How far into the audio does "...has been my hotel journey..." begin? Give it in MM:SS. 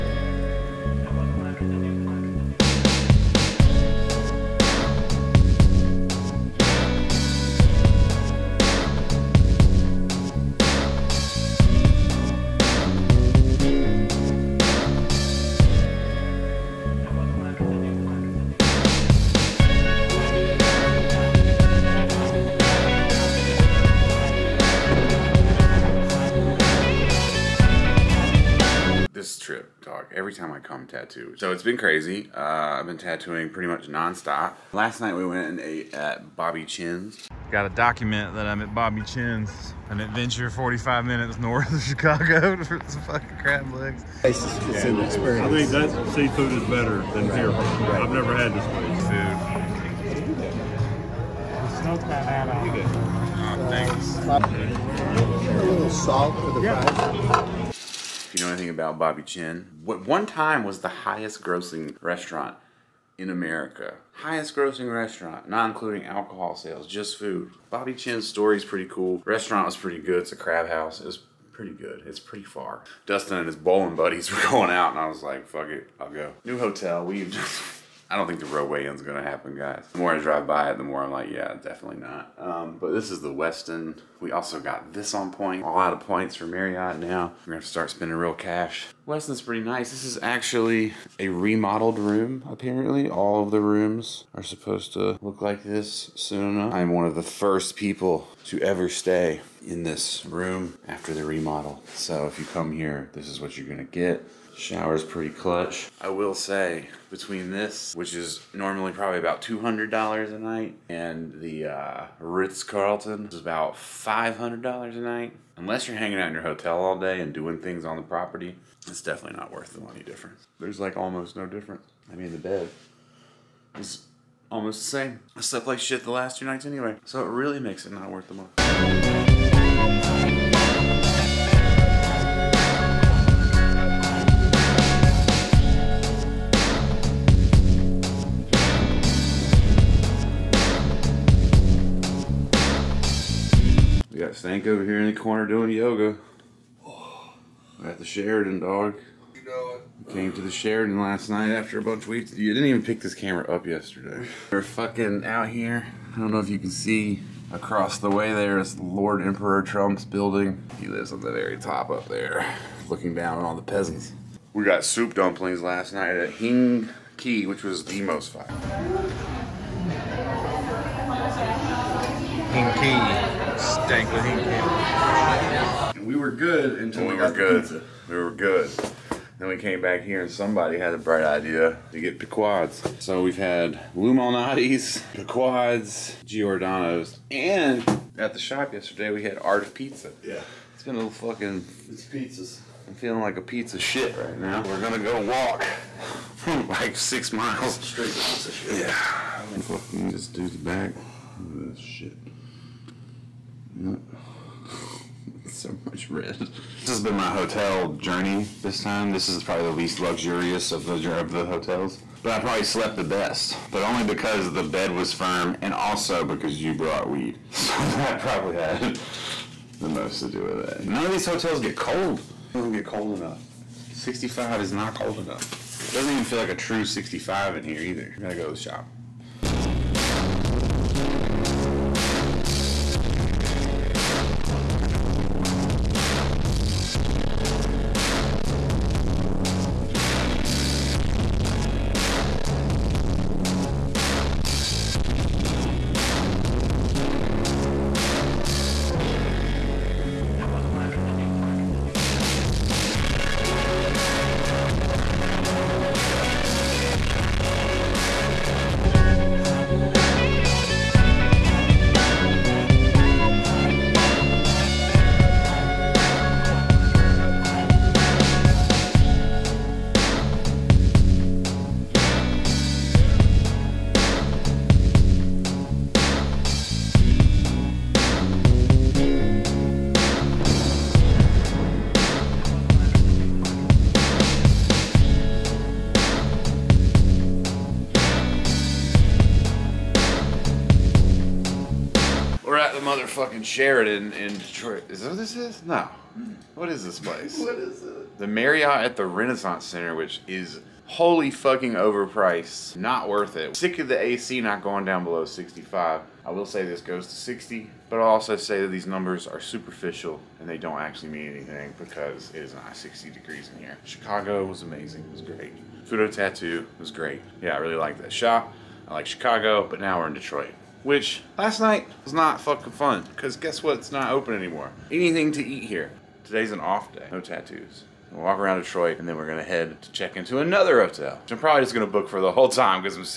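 03:26.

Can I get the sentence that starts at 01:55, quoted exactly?
Unless you're hanging out in your hotel all day and doing things on the property, it's definitely not worth the money difference.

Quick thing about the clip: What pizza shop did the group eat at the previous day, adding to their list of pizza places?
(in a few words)
Art of Pizza.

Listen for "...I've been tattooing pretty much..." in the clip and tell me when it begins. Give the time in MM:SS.
00:32.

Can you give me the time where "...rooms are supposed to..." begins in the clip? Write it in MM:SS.
01:33.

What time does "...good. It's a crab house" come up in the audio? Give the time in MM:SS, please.
01:09.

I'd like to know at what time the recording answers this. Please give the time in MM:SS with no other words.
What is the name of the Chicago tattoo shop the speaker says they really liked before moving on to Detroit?
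05:15.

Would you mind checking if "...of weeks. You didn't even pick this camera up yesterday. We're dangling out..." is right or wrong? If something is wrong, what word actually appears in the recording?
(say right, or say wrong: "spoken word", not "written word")
wrong: "fucking", not "dangling".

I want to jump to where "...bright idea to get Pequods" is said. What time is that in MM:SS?
03:00.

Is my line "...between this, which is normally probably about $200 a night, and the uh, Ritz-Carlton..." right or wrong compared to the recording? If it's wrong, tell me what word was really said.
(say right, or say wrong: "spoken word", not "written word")
right.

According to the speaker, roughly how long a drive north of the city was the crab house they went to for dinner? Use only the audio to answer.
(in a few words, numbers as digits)
45 minutes.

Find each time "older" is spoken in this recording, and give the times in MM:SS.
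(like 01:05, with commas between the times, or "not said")
not said.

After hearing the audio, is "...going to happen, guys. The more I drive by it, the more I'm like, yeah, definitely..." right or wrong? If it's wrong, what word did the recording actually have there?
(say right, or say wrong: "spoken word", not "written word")
right.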